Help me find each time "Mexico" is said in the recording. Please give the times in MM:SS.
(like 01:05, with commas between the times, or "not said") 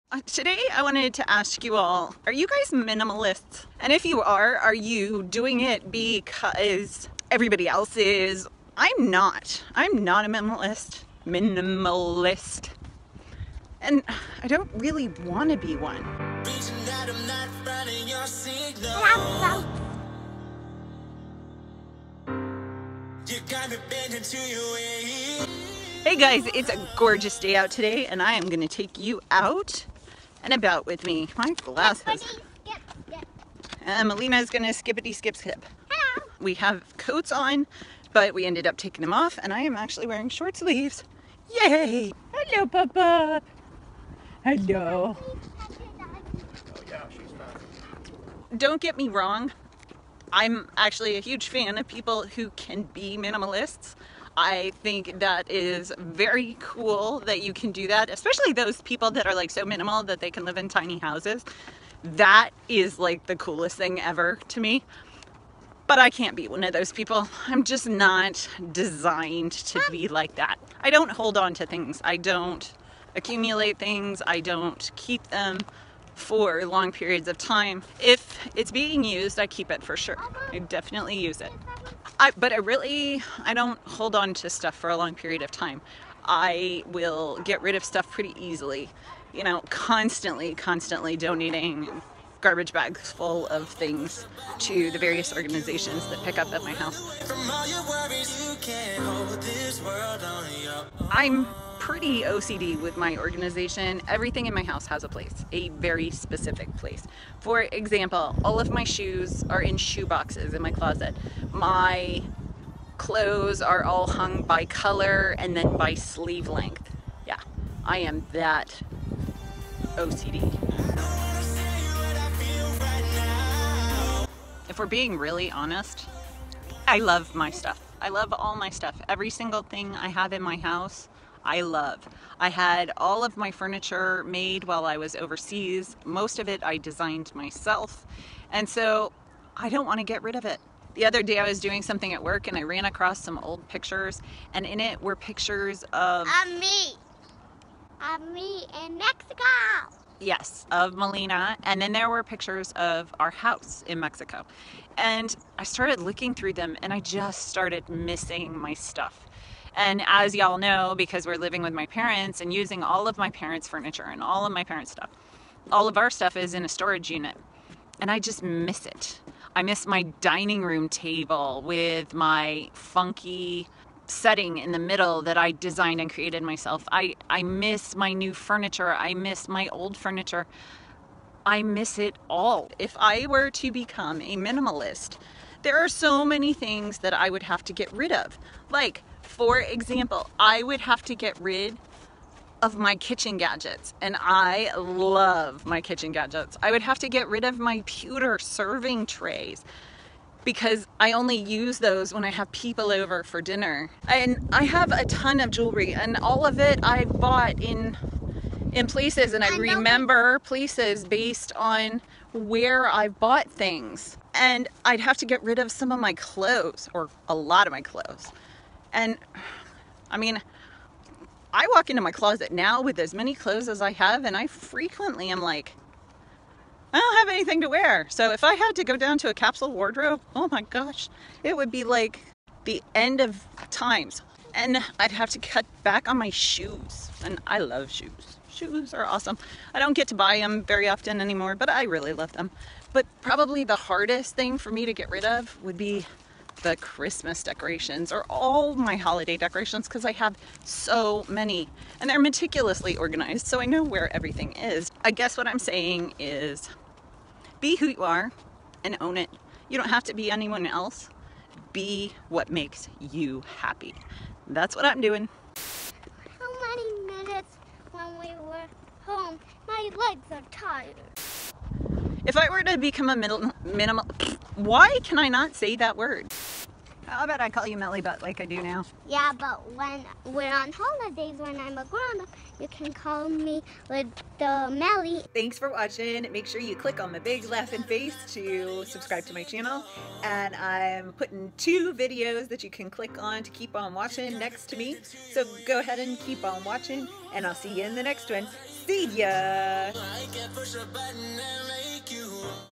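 02:28, 02:33.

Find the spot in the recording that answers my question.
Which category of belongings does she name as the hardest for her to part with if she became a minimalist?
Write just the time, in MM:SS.
04:06.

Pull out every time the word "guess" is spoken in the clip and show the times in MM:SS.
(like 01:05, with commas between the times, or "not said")
04:15.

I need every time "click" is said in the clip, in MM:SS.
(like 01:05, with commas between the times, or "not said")
04:46, 04:52.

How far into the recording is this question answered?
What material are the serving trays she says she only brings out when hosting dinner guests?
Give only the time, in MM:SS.
03:17.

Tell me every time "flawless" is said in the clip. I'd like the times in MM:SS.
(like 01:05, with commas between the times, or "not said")
not said.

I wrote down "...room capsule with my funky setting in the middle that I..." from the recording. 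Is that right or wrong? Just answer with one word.
wrong.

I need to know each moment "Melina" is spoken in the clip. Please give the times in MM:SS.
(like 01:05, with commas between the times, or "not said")
00:34, 02:30.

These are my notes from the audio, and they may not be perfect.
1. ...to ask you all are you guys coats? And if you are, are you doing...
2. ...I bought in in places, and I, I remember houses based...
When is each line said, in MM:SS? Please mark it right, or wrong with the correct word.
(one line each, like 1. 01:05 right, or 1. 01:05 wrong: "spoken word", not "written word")
1. 00:01 wrong: "minimalists", not "coats"
2. 03:26 wrong: "places", not "houses".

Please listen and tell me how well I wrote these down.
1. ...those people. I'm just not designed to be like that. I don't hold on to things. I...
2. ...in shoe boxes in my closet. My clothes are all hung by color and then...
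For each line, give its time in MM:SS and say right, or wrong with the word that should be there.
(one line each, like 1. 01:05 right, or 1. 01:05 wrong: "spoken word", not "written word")
1. 01:06 right
2. 01:49 right.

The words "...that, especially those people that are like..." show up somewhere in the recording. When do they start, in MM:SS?
00:57.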